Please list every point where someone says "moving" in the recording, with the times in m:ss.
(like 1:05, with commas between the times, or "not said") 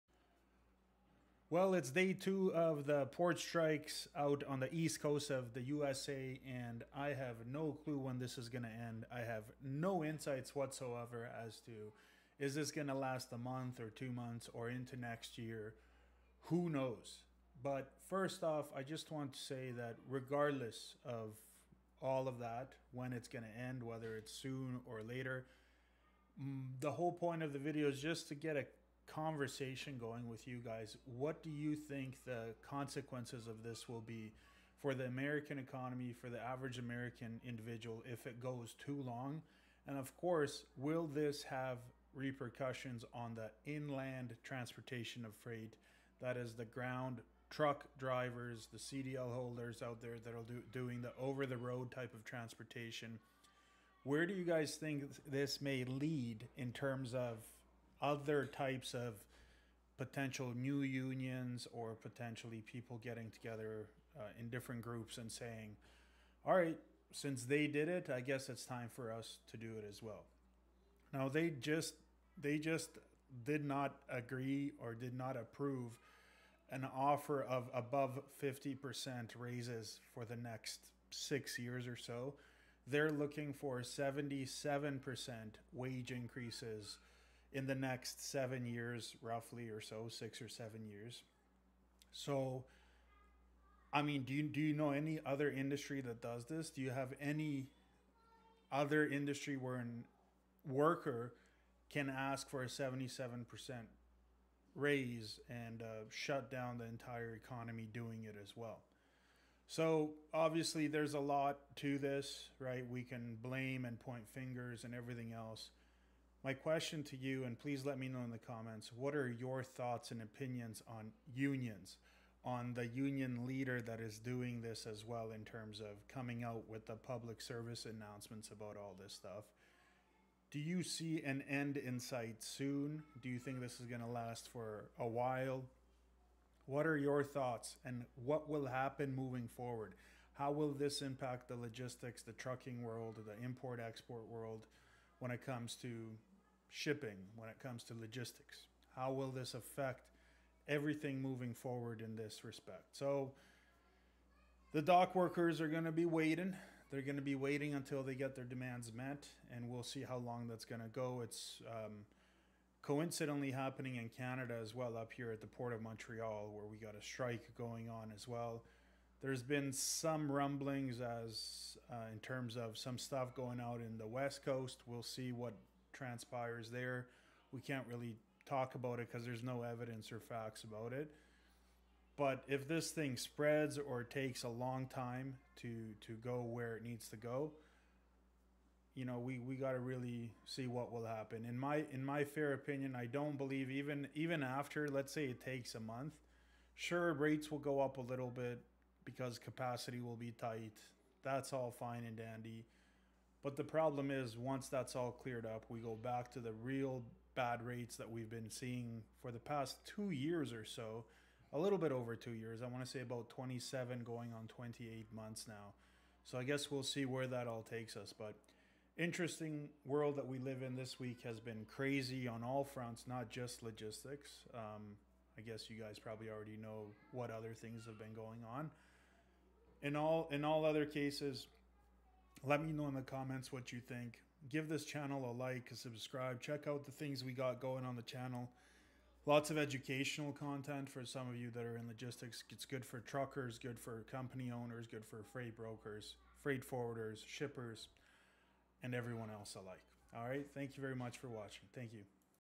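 2:19, 2:31.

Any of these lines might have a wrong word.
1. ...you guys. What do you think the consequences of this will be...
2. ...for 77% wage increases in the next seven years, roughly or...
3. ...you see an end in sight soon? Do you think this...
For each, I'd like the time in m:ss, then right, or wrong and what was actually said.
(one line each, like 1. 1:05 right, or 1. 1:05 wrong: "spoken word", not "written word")
1. 0:30 right
2. 1:23 right
3. 2:10 right.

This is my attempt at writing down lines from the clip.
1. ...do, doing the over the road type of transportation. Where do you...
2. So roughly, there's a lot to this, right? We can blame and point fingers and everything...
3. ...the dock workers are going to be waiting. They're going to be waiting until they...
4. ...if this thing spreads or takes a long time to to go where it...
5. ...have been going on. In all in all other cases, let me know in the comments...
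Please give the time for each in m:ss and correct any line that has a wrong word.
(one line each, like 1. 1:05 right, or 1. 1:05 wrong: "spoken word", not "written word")
1. 0:50 right
2. 1:49 wrong: "obviously", not "roughly"
3. 2:34 right
4. 3:02 right
5. 3:47 right.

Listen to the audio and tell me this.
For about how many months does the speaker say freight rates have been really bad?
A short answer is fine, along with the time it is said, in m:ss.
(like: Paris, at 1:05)
28 months, at 3:33.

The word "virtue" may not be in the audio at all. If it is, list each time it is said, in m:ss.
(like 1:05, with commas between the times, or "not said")
not said.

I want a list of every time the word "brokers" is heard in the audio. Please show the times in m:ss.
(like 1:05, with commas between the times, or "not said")
4:05.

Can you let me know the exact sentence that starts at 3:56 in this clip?
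Check out the things we got going on the channel.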